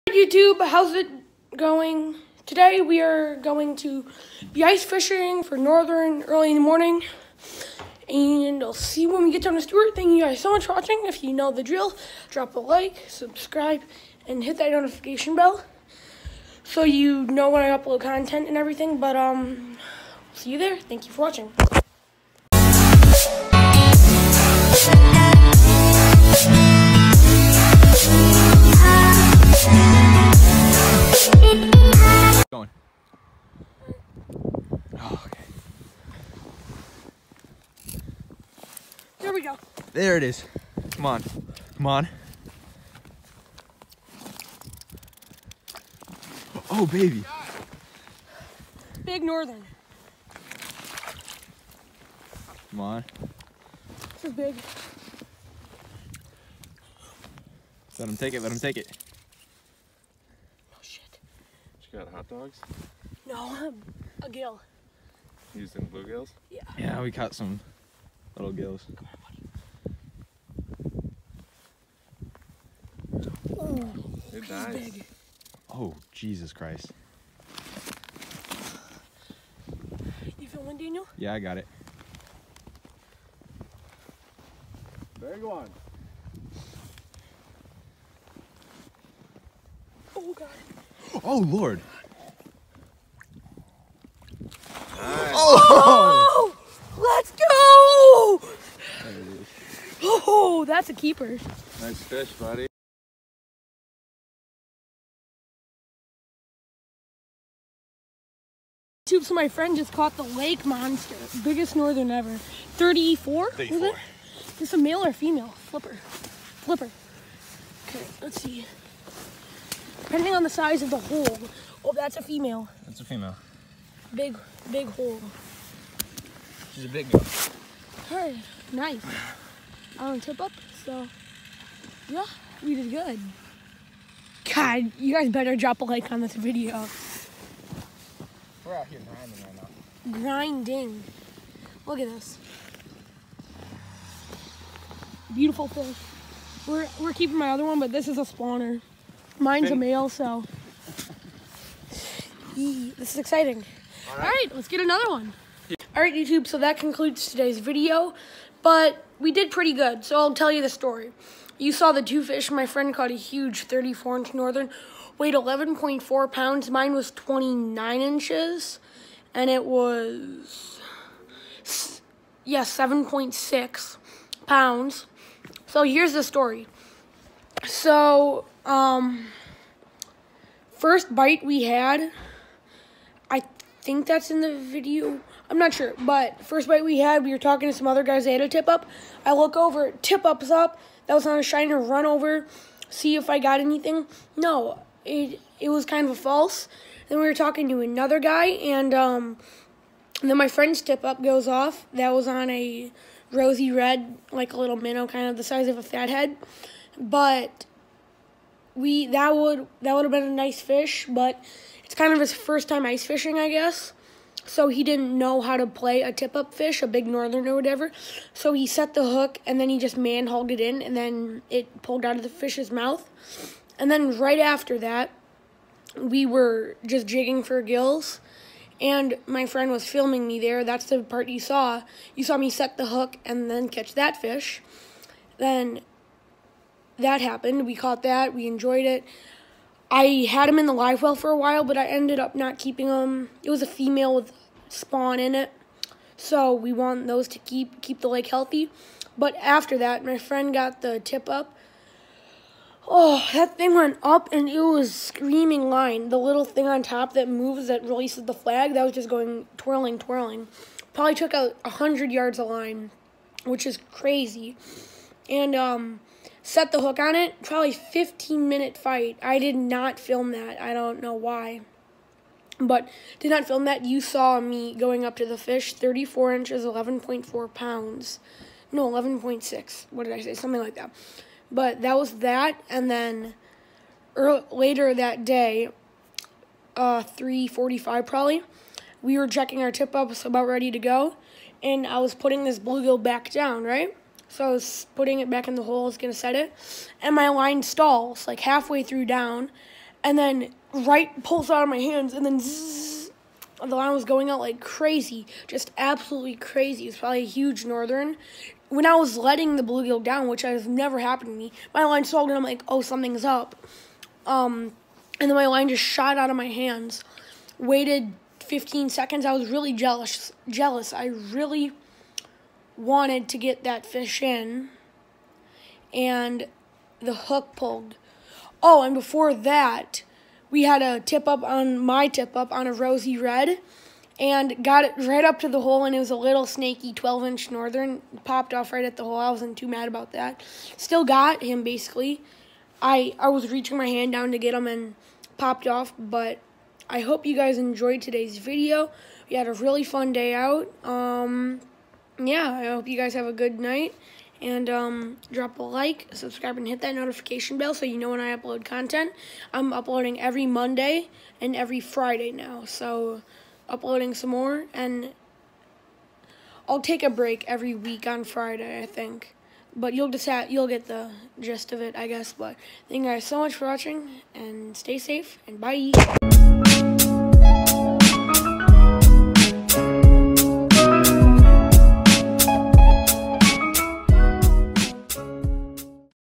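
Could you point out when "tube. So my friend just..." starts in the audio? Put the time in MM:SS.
01:49.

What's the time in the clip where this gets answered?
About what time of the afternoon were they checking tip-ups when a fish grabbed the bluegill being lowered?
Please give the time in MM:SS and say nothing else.
04:47.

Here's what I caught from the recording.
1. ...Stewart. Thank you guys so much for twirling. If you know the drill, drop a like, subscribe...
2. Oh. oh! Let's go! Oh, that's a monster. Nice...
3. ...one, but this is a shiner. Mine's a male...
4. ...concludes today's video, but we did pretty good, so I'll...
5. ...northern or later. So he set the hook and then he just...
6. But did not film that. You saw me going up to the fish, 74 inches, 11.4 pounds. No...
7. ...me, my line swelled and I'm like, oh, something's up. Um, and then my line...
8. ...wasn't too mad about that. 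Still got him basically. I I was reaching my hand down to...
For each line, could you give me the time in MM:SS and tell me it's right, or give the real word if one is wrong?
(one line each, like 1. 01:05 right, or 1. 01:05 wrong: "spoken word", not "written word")
1. 00:09 wrong: "watching", not "twirling"
2. 01:35 wrong: "keeper", not "monster"
3. 02:27 wrong: "spawner", not "shiner"
4. 02:36 right
5. 03:37 wrong: "whatever", not "later"
6. 04:32 wrong: "34", not "74"
7. 05:11 right
8. 05:39 right.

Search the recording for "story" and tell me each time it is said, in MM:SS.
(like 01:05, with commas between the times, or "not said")
02:40, 02:56.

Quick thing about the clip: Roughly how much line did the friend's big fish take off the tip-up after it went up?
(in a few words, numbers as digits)
100 yards.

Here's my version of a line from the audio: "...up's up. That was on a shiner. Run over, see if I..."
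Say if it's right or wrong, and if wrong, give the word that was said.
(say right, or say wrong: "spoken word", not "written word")
right.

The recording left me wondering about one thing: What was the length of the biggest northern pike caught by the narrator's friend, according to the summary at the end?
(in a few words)
34 inches.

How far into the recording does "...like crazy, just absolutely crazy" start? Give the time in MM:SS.
05:04.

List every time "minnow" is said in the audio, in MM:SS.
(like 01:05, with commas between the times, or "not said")
03:24.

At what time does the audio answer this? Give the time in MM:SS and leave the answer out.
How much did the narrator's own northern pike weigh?
02:52.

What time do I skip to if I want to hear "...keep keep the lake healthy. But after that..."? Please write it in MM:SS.
04:07.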